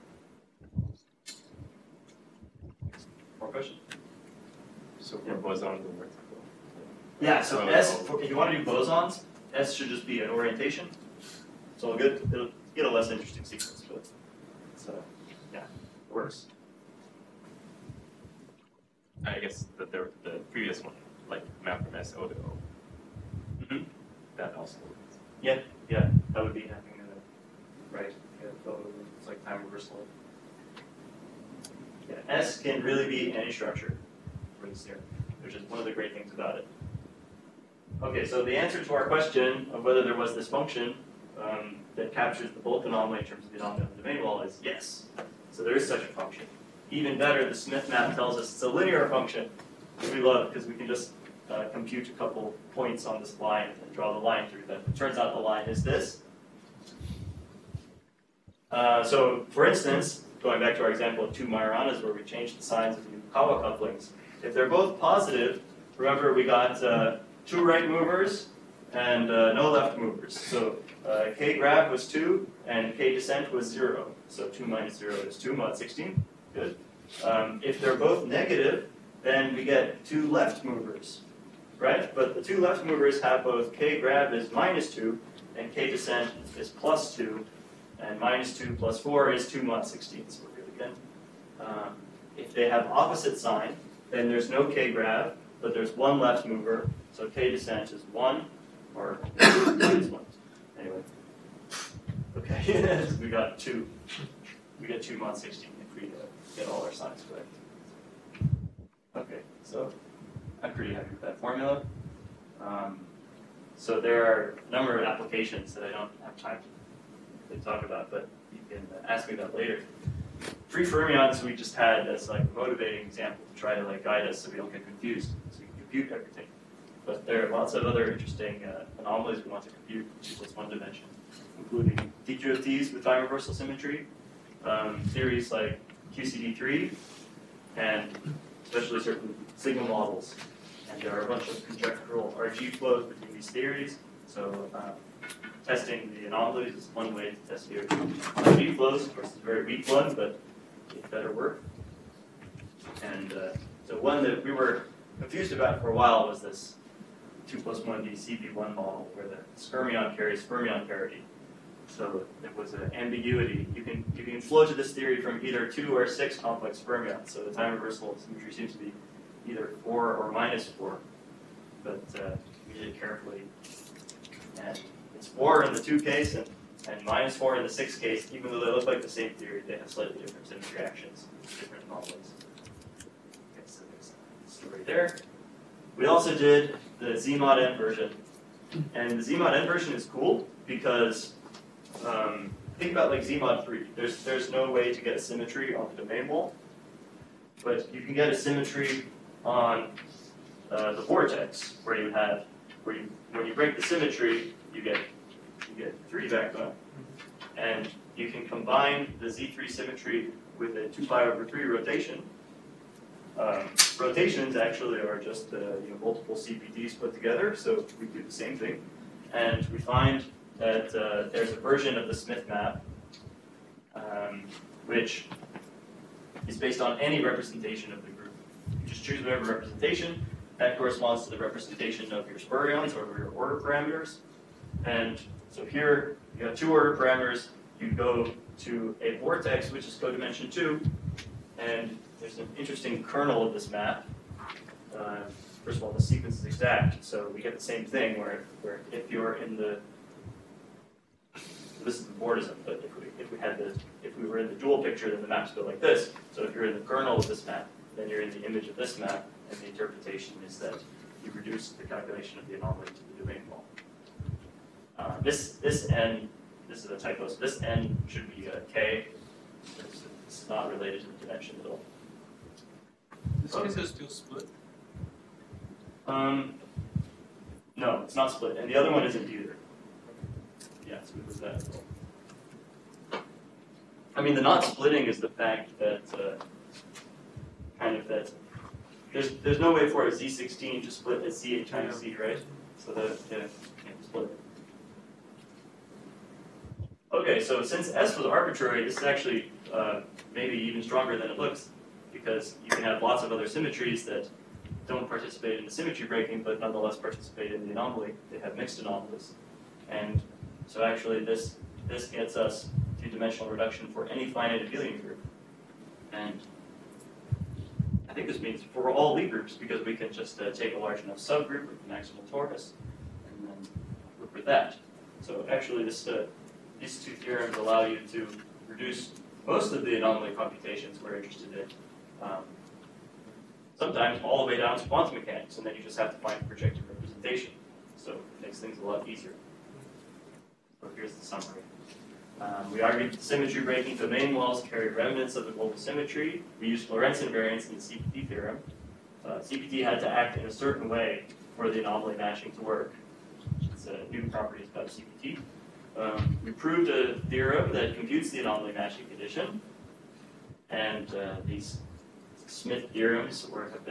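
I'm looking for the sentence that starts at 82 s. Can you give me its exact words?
But the two left movers have both k grab is minus 2 and k descent is plus 2.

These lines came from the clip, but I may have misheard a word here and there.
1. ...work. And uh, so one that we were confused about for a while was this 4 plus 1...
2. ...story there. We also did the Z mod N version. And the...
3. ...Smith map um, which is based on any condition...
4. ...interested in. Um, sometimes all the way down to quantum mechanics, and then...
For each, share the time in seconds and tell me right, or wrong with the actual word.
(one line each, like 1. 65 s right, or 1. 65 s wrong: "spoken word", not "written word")
1. 151 s wrong: "2", not "4"
2. 184 s right
3. 222 s wrong: "representation", not "condition"
4. 331 s right.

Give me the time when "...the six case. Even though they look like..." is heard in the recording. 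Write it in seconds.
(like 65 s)
177 s.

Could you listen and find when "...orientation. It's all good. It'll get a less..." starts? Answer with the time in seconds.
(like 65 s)
10 s.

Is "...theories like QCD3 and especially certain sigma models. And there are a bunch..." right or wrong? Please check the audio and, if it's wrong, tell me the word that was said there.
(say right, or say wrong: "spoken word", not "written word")
right.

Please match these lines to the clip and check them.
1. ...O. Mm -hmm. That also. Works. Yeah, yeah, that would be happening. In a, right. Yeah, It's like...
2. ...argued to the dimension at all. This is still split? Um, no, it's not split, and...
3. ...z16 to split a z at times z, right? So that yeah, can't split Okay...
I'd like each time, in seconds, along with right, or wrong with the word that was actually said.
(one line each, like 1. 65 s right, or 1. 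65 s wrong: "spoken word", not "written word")
1. 22 s right
2. 270 s wrong: "related", not "argued"
3. 290 s right.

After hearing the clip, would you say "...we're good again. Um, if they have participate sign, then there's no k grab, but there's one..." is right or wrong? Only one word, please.
wrong.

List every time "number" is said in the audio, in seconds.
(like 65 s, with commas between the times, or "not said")
114 s.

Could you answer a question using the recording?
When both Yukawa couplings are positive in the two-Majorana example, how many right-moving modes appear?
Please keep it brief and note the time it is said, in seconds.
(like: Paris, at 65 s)
2, at 67 s.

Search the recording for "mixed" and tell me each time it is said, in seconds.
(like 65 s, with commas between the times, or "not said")
308 s.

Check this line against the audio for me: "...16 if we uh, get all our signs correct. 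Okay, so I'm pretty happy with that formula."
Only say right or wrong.
right.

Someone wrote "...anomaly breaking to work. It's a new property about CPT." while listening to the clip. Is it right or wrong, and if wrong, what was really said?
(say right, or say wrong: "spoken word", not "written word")
wrong: "matching", not "breaking".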